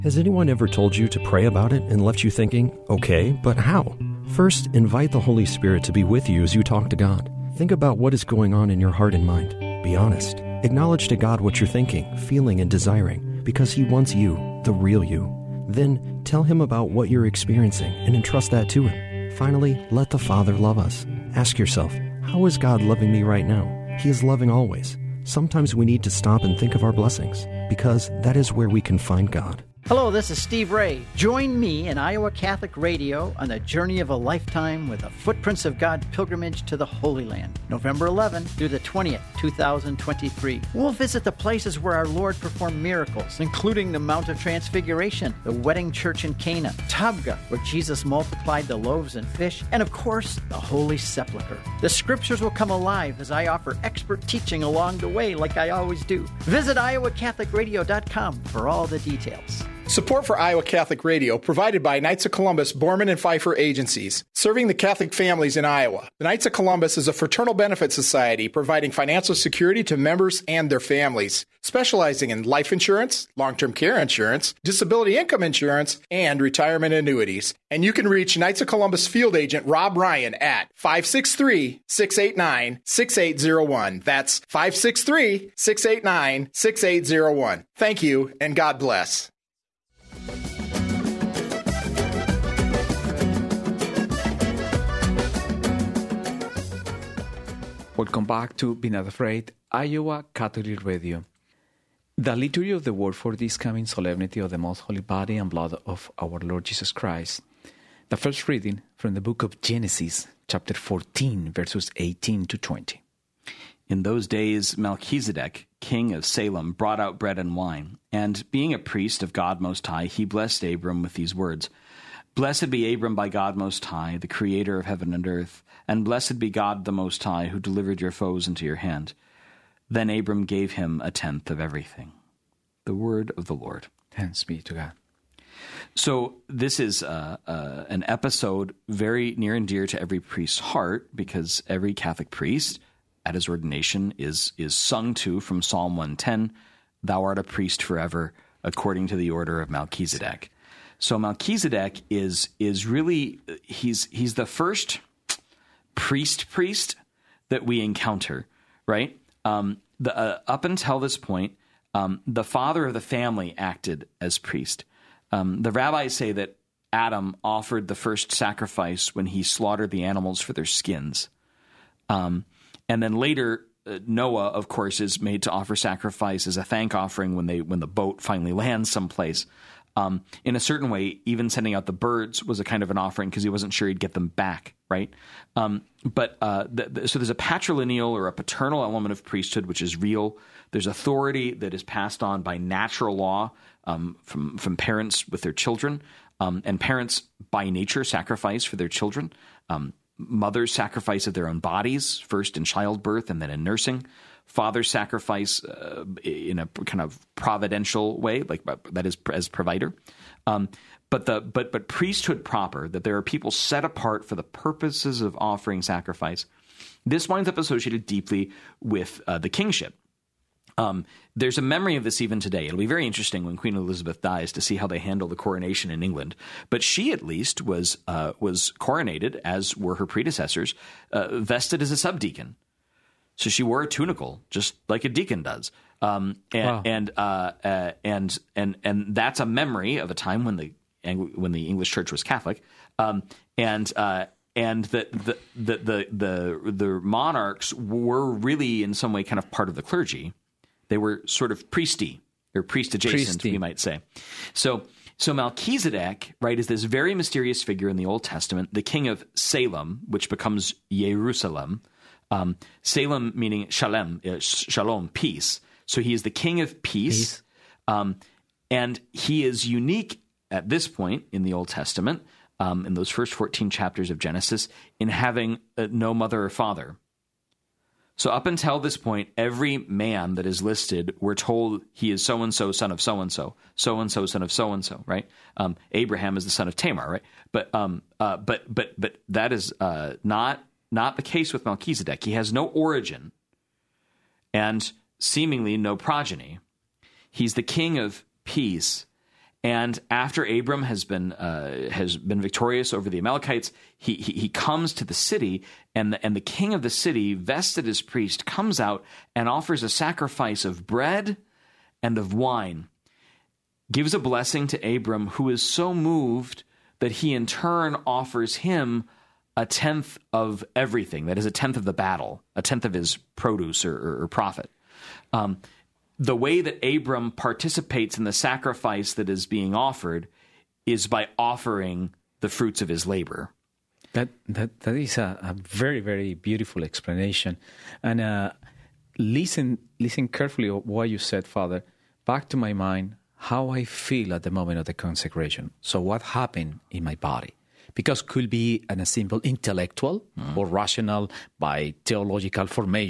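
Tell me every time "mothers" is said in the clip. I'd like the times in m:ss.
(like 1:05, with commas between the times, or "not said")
3:20, 4:36.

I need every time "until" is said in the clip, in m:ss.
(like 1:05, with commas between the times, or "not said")
2:40, 4:38.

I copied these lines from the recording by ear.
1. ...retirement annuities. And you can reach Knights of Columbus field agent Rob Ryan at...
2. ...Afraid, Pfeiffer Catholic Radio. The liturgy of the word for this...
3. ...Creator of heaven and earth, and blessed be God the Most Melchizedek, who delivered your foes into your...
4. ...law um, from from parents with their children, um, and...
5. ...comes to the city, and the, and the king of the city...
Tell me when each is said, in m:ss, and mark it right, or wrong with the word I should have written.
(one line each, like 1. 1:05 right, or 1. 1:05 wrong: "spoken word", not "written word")
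1. 1:16 right
2. 1:39 wrong: "Iowa", not "Pfeiffer"
3. 2:04 wrong: "High", not "Melchizedek"
4. 3:13 right
5. 5:04 right.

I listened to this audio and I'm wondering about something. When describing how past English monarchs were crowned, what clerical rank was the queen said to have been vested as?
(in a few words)
subdeacon.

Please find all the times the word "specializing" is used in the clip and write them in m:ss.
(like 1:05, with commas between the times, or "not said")
1:11.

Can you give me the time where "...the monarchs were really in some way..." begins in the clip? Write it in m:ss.
4:06.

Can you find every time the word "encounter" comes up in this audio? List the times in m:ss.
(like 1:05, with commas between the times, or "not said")
2:37.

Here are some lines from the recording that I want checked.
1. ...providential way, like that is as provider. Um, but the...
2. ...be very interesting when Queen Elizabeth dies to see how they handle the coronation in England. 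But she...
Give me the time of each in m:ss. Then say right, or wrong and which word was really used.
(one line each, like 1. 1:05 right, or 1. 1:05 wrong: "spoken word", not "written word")
1. 3:27 right
2. 3:42 right.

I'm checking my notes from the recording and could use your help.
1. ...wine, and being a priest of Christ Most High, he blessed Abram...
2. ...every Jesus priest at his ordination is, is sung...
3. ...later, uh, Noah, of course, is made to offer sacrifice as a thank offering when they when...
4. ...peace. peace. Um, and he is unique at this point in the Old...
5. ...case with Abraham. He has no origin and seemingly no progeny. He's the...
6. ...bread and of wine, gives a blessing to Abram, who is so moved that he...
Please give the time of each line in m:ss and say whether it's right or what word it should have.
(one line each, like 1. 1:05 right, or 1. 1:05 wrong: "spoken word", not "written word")
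1. 1:57 wrong: "God", not "Christ"
2. 2:21 wrong: "Catholic", not "Jesus"
3. 2:53 right
4. 4:26 right
5. 4:51 wrong: "Melchizedek", not "Abraham"
6. 5:10 right.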